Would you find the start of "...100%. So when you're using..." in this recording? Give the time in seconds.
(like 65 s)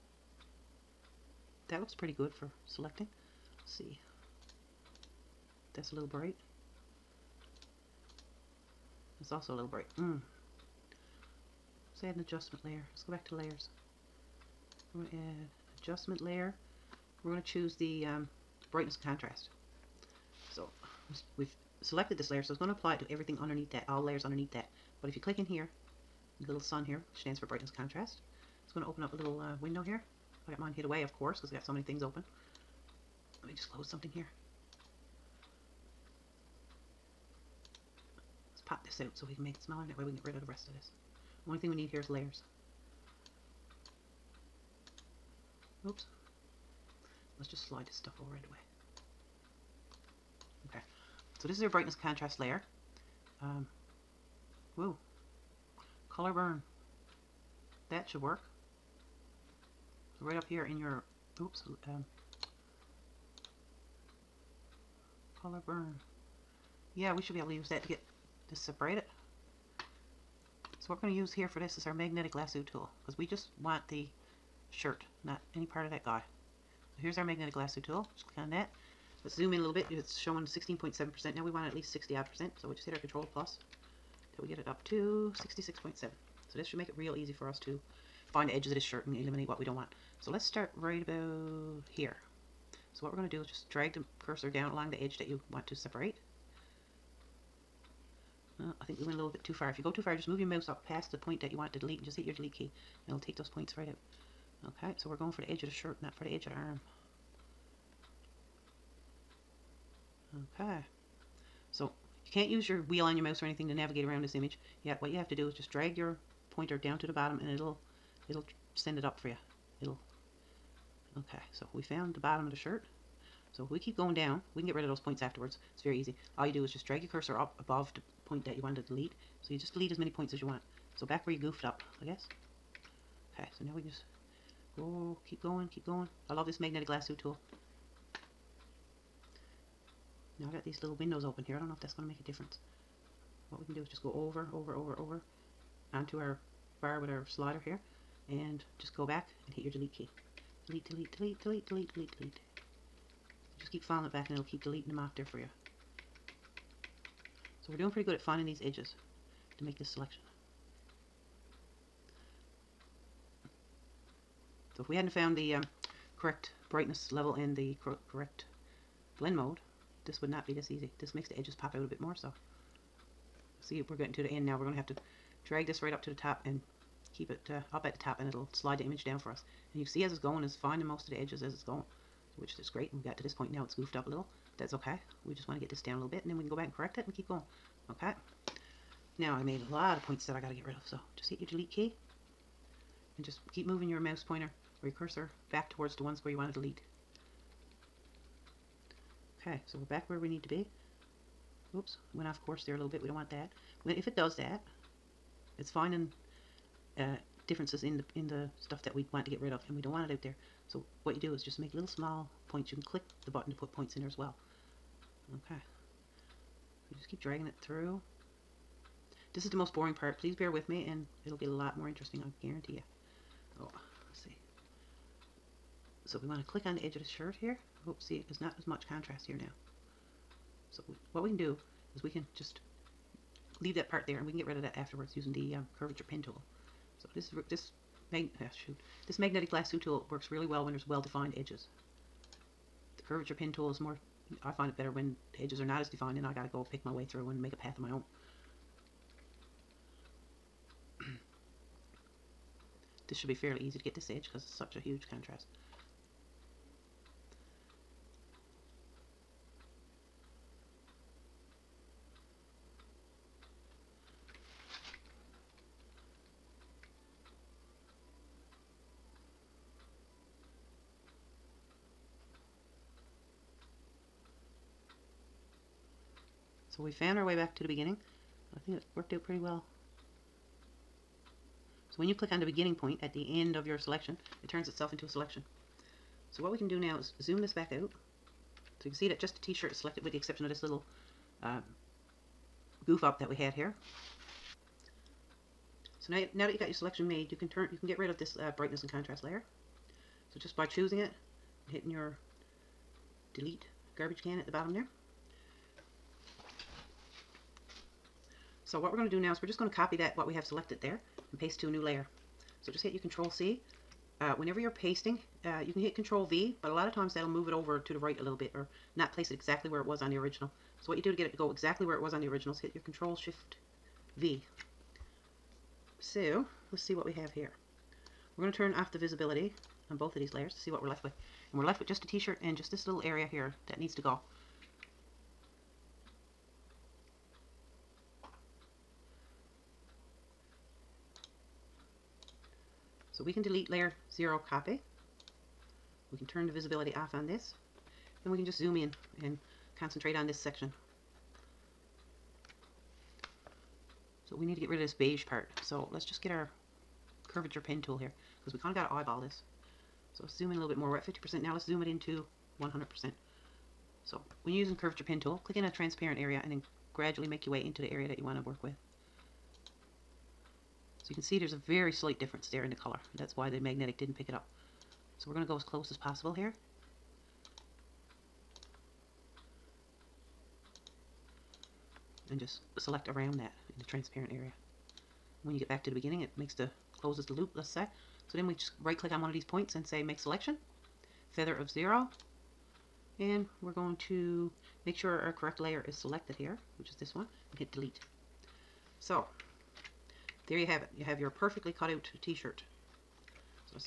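362 s.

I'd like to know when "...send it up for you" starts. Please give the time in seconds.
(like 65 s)
118 s.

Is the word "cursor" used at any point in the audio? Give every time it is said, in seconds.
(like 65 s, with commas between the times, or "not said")
94 s, 127 s, 194 s.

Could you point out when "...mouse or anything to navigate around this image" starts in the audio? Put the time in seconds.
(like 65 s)
113 s.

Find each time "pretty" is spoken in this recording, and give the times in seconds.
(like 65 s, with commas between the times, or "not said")
1 s, 157 s, 279 s.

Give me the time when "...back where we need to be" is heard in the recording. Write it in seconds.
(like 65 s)
199 s.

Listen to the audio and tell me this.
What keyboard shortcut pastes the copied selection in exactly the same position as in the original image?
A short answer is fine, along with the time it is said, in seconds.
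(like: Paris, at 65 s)
Control Shift V, at 322 s.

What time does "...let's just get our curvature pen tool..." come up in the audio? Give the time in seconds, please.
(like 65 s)
355 s.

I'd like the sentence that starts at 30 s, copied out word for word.
I got mine hid away, of course, because I got so many things open.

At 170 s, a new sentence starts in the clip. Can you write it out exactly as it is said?
This makes the edges pop out a bit more so.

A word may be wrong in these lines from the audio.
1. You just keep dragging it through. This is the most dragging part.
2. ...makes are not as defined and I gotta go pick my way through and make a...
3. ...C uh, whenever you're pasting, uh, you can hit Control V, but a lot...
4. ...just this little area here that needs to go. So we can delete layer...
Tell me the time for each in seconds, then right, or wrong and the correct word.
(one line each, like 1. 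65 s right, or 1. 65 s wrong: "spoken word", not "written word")
1. 216 s wrong: "boring", not "dragging"
2. 245 s wrong: "edges", not "makes"
3. 313 s right
4. 332 s right.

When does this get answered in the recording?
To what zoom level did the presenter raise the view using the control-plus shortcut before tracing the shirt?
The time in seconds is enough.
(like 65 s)
85 s.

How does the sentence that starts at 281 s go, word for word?
So when you click on the beginning point at the end of your selection, it turns itself into a selection.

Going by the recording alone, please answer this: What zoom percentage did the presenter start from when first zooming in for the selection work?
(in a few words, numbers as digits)
16.7%.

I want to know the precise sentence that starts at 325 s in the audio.
So let's see what we have here.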